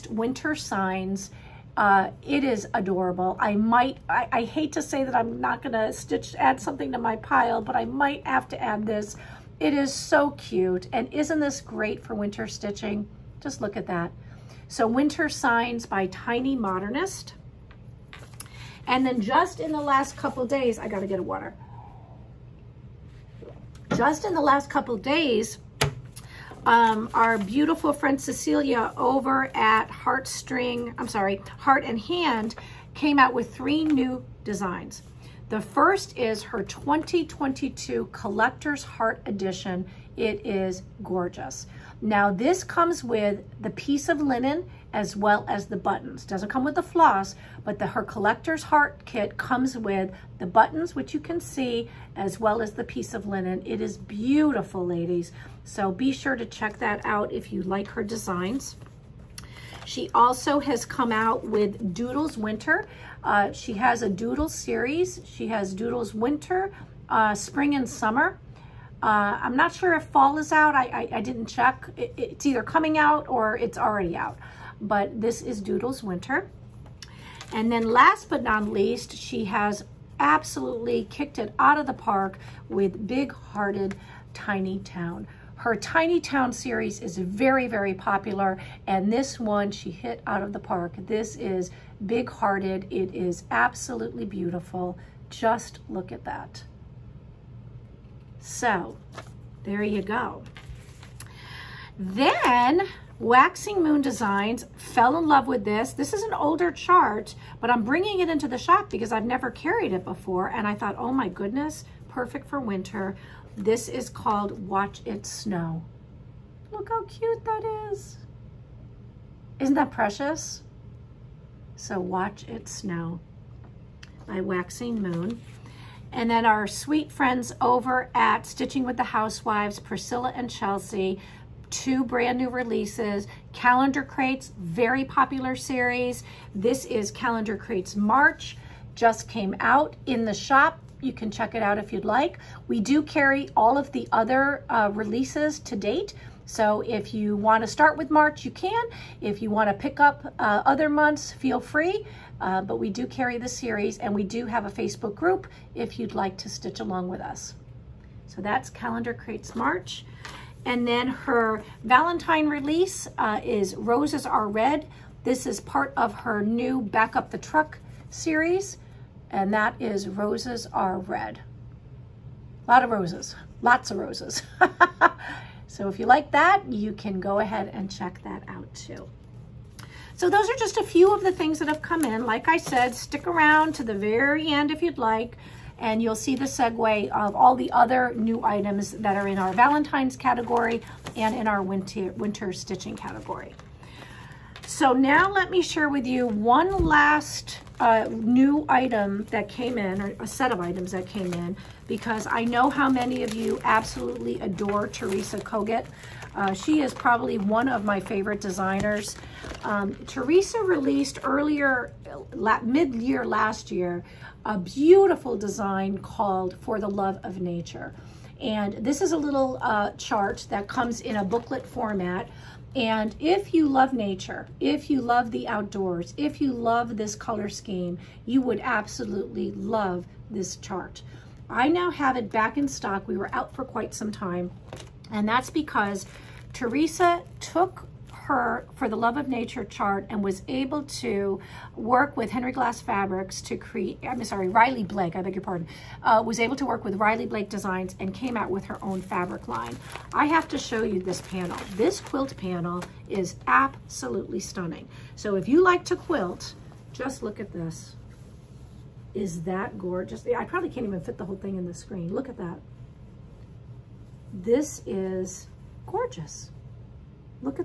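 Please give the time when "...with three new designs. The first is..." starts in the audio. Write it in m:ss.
0:33.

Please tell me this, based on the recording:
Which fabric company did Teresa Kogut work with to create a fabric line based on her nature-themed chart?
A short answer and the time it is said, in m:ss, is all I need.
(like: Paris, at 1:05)
Riley Blake Designs, at 4:06.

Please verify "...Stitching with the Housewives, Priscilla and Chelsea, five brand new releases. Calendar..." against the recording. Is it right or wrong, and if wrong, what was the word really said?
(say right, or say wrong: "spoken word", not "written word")
wrong: "two", not "five".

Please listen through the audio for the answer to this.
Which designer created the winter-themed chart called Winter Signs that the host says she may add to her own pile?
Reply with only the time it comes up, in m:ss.
0:16.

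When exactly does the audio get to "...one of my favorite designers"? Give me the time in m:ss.
3:27.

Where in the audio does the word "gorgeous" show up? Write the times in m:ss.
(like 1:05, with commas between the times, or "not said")
0:41, 4:19, 4:25.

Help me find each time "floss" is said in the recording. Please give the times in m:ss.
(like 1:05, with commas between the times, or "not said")
0:46.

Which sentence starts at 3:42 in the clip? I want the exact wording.
And if you love nature, if you love the outdoors, if you love this color scheme, you would absolutely love this chart.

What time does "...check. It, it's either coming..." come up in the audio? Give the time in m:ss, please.
1:11.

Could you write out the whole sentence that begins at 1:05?
She has Doodles Winter, uh, Spring and Summer.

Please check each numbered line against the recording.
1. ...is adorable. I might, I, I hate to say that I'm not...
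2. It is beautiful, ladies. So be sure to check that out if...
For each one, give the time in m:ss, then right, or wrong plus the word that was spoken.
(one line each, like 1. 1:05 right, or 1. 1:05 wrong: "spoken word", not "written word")
1. 0:02 right
2. 0:53 right.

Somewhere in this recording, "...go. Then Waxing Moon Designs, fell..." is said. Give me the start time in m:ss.
1:40.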